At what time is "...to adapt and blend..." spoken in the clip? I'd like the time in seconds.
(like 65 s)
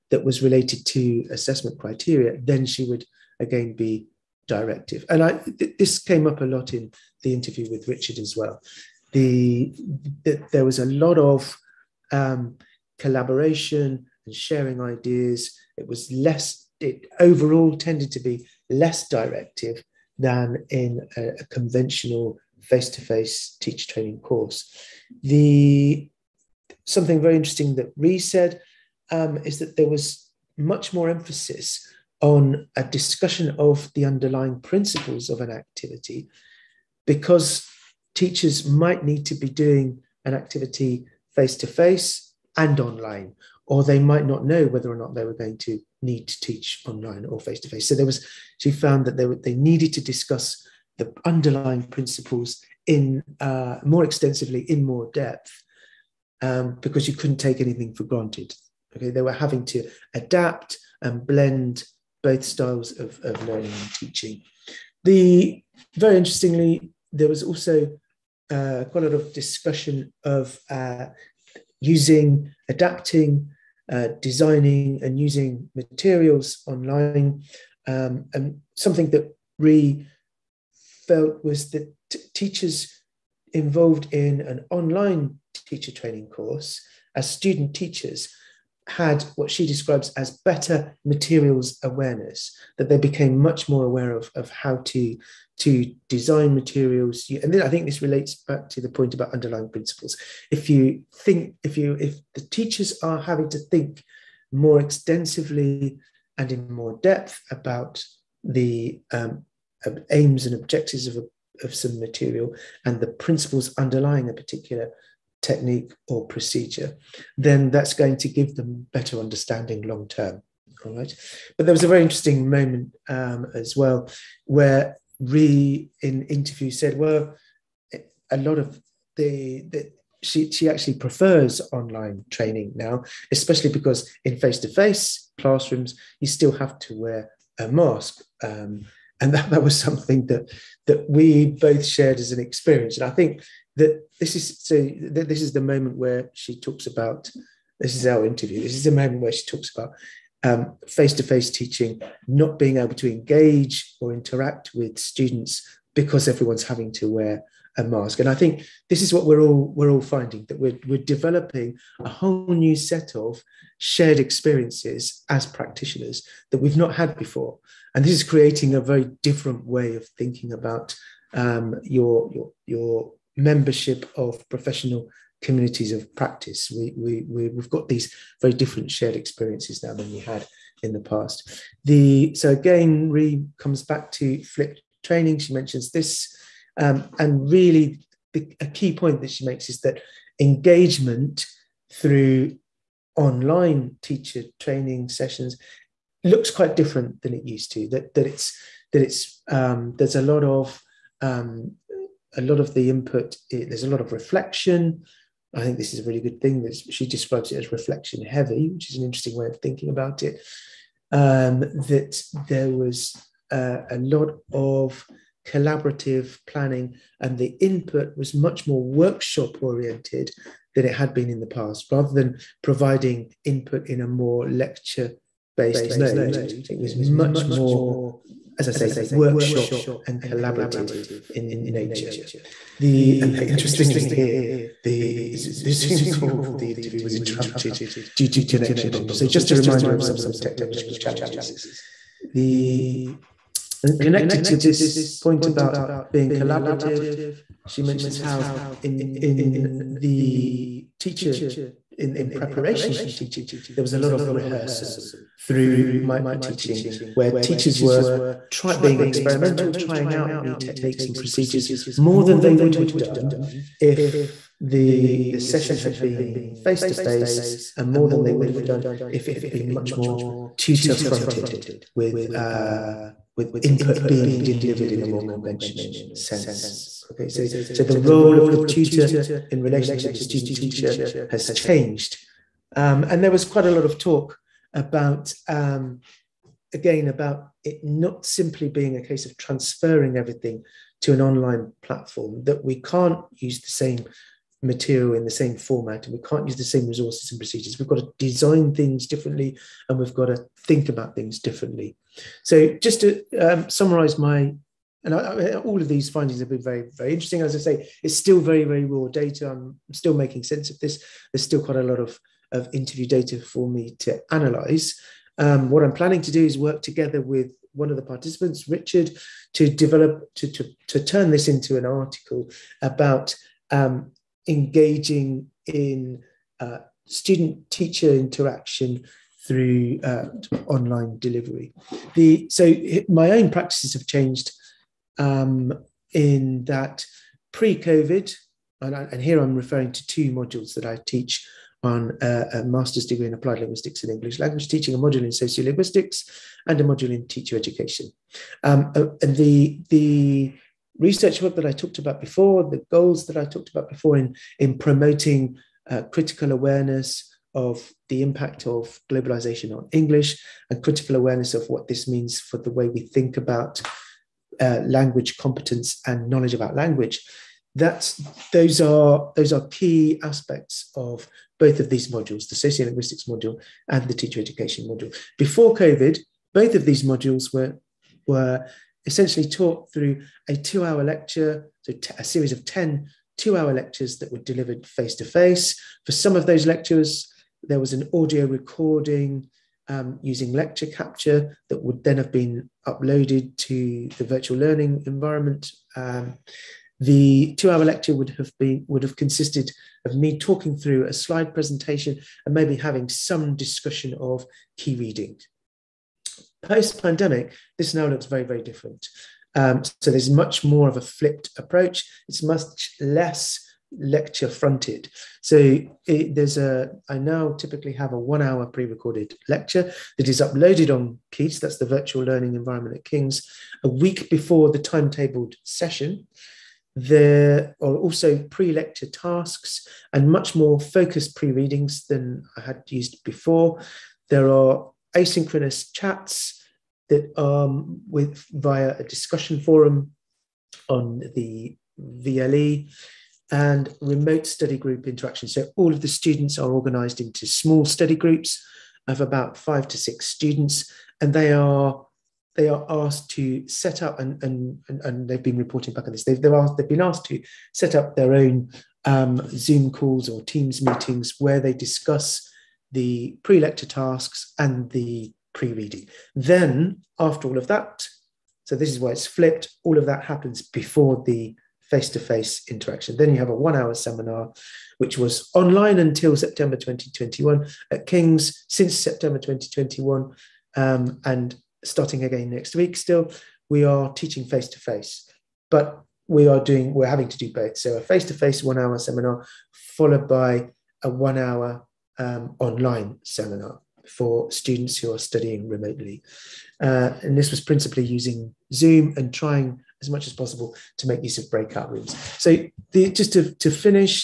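59 s.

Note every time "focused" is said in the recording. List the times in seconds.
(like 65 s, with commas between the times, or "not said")
430 s.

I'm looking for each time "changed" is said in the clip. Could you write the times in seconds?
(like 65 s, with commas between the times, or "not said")
281 s, 334 s.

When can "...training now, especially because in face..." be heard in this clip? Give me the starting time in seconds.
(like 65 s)
132 s.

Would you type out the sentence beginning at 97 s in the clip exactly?
And then I think this relates back to the point about underlying principles.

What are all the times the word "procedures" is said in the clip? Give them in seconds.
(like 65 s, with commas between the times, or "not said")
116 s, 261 s, 297 s.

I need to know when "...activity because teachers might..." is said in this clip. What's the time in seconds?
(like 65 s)
35 s.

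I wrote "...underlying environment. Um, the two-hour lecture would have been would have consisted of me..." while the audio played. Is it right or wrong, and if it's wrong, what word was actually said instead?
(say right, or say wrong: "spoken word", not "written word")
wrong: "learning", not "underlying".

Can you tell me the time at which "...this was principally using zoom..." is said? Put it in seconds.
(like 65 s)
497 s.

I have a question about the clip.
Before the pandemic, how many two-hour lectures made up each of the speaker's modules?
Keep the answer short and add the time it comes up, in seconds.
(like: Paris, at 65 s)
10, at 382 s.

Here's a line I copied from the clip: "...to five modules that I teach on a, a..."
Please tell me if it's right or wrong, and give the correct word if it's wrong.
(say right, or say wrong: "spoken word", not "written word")
wrong: "two", not "five".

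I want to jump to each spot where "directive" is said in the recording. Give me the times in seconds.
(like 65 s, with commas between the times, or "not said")
4 s, 19 s.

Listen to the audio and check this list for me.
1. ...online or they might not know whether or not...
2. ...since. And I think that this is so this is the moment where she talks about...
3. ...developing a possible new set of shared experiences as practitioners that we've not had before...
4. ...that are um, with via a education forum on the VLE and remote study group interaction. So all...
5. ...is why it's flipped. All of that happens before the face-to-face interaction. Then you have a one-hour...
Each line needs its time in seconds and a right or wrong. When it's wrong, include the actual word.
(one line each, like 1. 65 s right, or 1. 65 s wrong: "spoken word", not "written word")
1. 42 s right
2. 142 s wrong: "experience", not "since"
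3. 161 s wrong: "whole", not "possible"
4. 437 s wrong: "discussion", not "education"
5. 468 s right.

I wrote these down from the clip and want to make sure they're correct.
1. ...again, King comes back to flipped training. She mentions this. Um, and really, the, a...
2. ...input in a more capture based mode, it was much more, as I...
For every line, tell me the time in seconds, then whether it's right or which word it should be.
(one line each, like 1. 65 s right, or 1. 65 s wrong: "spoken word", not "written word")
1. 182 s wrong: "Ree", not "King"
2. 223 s wrong: "lecture", not "capture".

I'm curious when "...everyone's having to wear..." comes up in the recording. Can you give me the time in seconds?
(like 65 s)
156 s.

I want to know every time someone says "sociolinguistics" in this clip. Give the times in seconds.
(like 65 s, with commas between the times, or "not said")
345 s, 372 s.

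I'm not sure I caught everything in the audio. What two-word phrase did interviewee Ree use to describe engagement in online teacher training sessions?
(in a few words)
reflection heavy.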